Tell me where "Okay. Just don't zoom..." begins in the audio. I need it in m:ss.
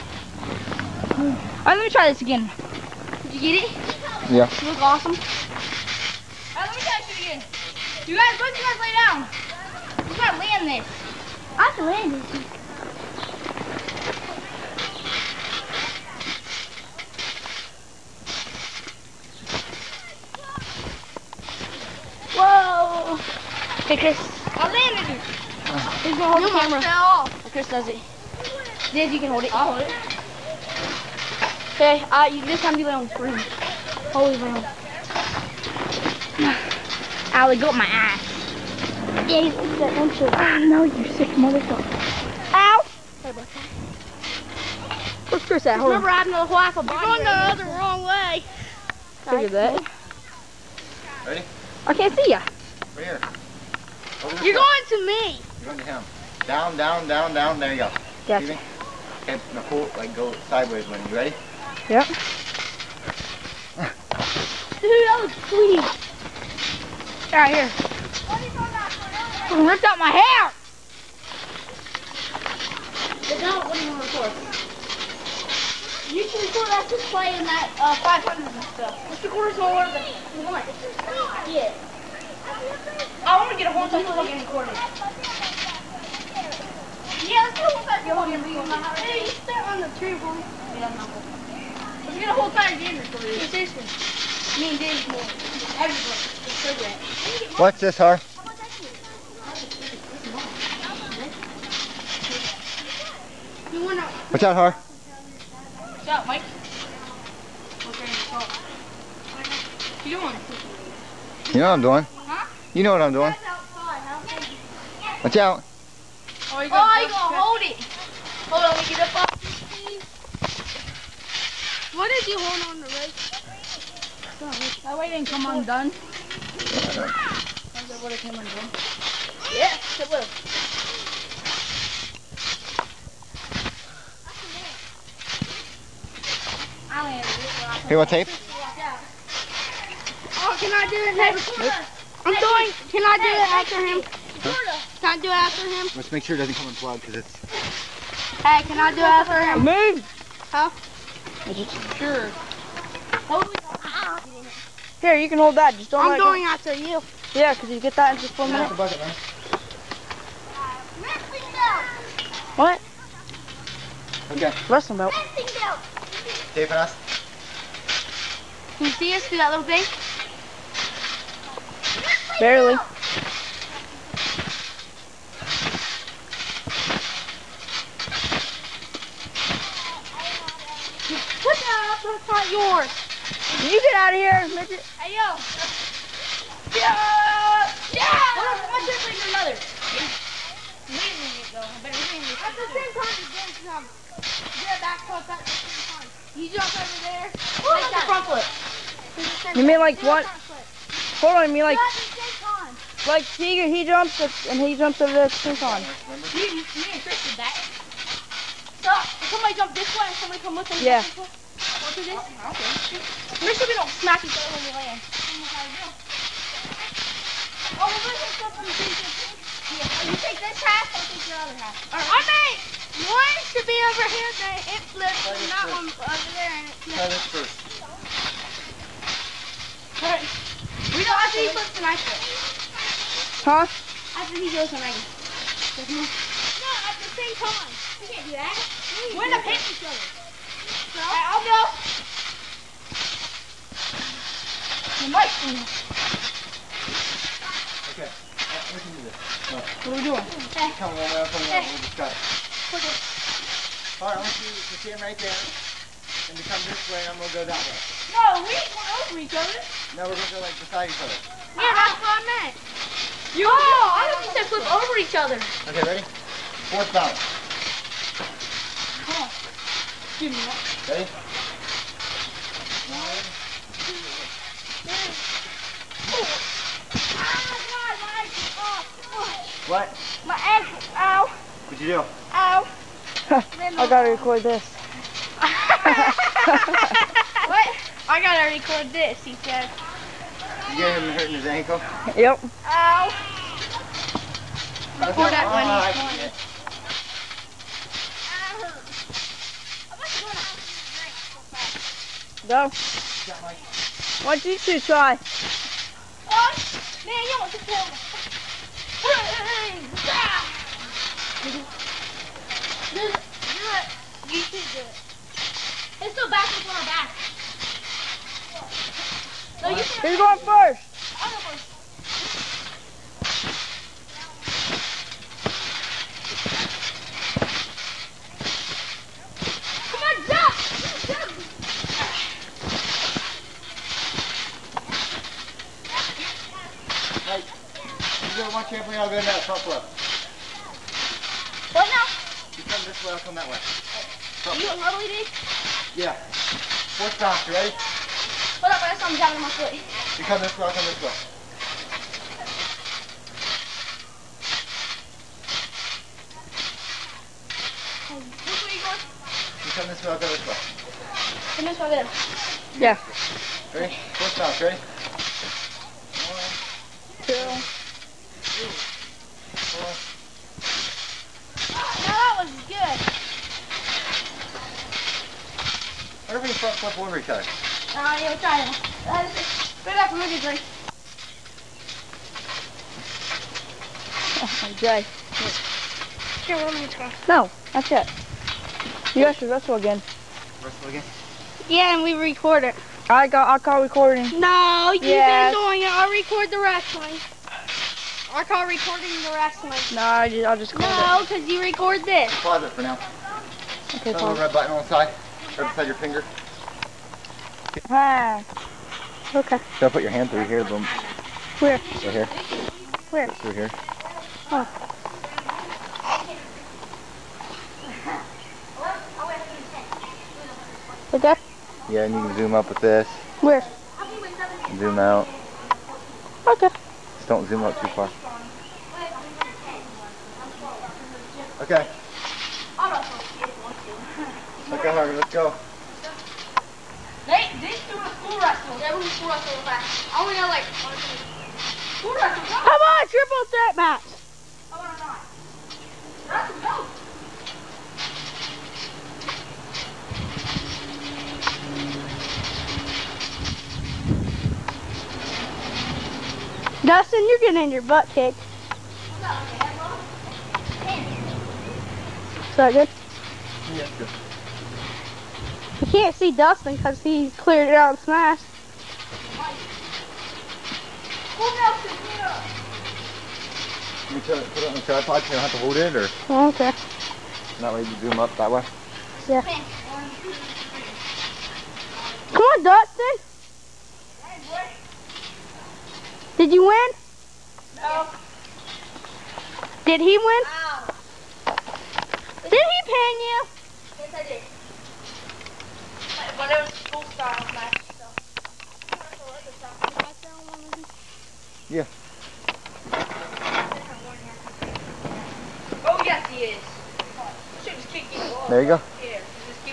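7:06.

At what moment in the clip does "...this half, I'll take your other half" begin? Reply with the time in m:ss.
3:40.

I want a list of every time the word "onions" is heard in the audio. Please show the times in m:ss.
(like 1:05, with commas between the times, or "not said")
not said.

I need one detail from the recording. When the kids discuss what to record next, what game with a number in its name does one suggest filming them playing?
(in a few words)
500.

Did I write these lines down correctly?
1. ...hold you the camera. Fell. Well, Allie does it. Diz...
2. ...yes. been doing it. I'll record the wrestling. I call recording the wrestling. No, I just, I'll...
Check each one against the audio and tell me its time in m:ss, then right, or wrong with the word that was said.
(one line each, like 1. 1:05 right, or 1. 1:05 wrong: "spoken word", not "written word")
1. 0:26 wrong: "Chris", not "Allie"
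2. 6:35 right.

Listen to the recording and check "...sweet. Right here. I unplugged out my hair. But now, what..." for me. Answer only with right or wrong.
wrong.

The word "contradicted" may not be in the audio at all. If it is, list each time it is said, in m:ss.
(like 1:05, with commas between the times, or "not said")
not said.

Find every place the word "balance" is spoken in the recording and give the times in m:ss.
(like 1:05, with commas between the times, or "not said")
4:26.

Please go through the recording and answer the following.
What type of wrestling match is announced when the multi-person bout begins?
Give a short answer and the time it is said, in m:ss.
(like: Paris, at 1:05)
triple threat match, at 7:23.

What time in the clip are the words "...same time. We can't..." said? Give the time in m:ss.
3:57.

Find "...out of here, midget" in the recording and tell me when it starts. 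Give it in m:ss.
3:03.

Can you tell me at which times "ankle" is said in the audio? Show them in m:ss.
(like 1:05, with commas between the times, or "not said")
4:40, 4:51.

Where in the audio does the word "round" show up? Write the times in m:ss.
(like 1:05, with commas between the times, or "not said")
0:34.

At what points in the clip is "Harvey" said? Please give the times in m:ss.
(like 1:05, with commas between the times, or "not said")
7:14.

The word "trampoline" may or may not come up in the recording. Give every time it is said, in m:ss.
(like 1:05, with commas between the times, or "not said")
5:38.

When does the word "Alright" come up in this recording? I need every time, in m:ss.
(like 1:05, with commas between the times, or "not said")
0:05, 3:50, 4:13.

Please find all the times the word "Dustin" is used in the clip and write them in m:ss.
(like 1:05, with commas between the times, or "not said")
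7:36, 7:46, 8:02.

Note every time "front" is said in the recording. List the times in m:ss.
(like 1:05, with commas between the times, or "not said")
3:18, 5:39, 5:44, 6:16.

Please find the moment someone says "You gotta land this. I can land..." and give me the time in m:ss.
0:10.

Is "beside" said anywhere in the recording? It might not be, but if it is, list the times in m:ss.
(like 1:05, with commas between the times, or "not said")
4:20, 6:45.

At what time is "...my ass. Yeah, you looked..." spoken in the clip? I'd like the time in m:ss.
0:37.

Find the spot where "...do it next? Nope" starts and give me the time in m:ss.
2:20.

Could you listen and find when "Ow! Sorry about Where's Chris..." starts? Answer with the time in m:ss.
0:42.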